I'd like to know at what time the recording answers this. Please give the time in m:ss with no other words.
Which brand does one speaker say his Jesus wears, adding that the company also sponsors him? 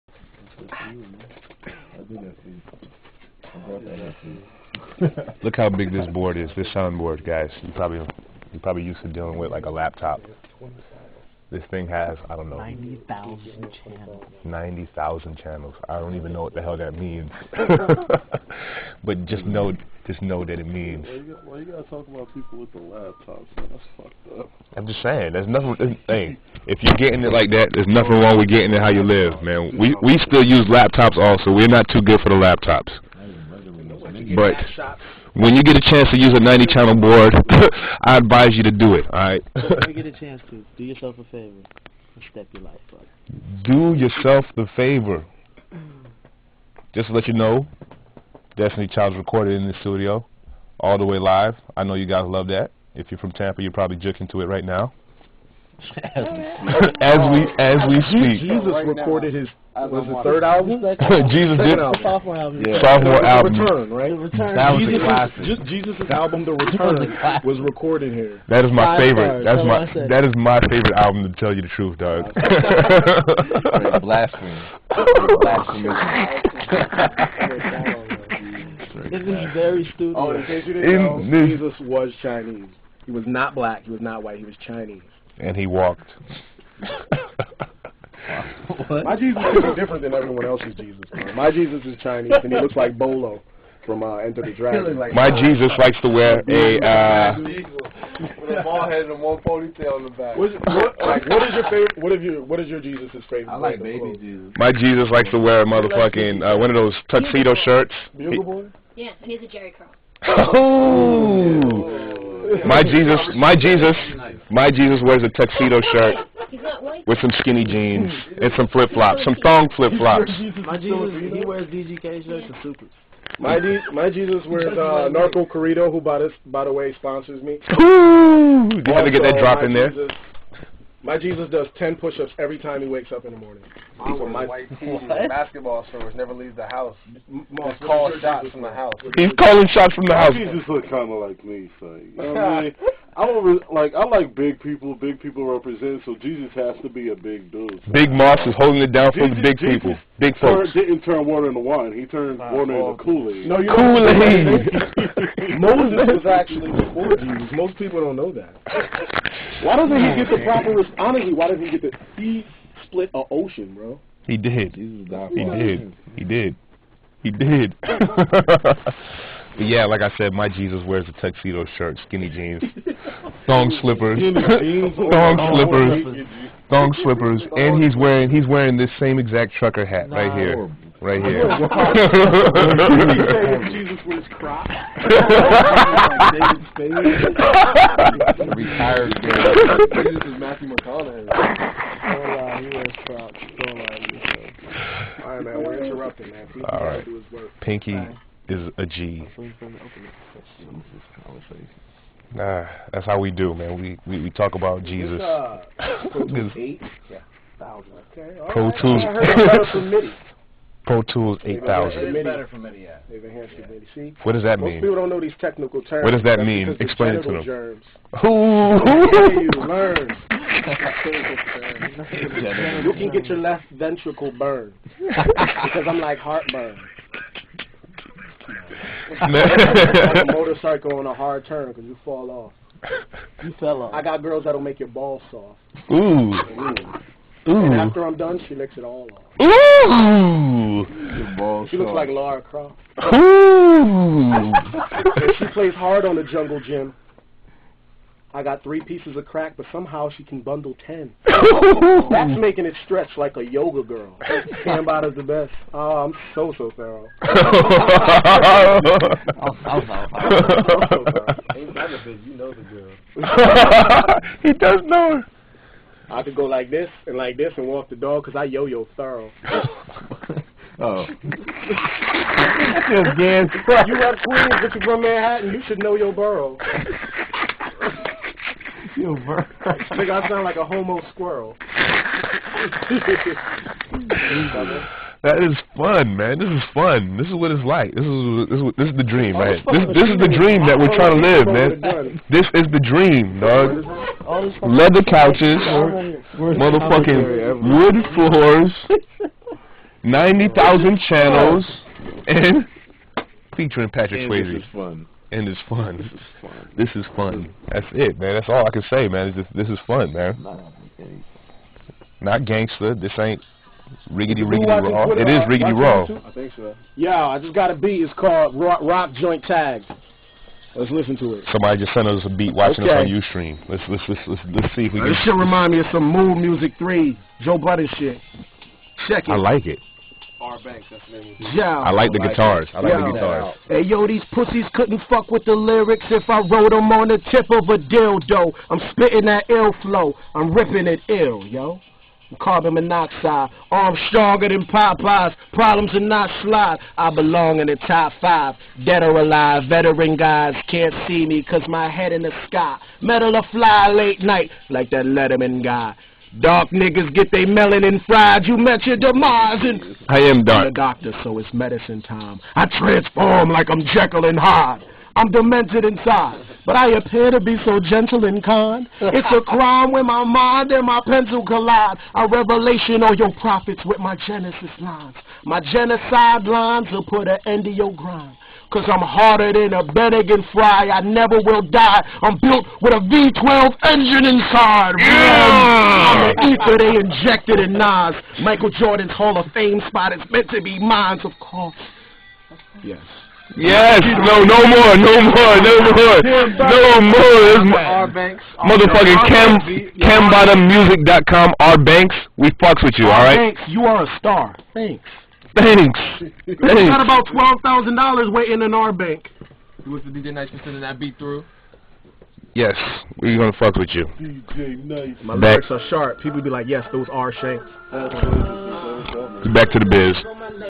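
2:05.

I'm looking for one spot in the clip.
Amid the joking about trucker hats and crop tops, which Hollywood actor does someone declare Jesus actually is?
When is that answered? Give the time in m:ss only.
3:10.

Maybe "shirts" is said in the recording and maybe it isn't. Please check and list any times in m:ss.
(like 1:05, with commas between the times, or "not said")
1:47, 1:55, 2:02, 2:51.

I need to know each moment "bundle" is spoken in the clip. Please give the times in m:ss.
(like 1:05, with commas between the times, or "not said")
4:10.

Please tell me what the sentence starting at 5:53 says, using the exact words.
Metal or fly late night, like that Letterman guy.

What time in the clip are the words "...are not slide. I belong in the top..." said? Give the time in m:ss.
5:45.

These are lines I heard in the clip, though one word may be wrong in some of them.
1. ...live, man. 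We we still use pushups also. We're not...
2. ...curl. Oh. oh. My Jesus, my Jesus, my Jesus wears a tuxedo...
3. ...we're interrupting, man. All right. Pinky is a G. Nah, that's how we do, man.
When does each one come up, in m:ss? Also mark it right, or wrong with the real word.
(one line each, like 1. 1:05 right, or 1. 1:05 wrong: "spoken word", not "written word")
1. 0:29 wrong: "laptops", not "pushups"
2. 1:49 right
3. 3:15 right.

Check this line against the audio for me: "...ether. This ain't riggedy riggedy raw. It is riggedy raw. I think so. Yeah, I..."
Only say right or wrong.
wrong.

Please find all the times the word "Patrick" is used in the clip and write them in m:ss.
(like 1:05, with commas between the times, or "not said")
5:03.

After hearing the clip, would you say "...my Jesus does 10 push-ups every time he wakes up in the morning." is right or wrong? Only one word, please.
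right.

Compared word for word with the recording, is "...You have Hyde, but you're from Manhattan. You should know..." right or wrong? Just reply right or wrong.
wrong.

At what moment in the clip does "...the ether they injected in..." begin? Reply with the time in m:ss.
6:26.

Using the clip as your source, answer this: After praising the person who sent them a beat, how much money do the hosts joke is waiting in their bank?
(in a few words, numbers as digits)
$12,000.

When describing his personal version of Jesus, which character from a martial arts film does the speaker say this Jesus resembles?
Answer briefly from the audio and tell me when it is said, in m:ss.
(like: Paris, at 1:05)
Bolo, at 1:32.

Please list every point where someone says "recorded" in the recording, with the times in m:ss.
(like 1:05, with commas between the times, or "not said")
0:49, 0:58, 1:07.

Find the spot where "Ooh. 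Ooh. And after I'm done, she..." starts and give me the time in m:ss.
3:56.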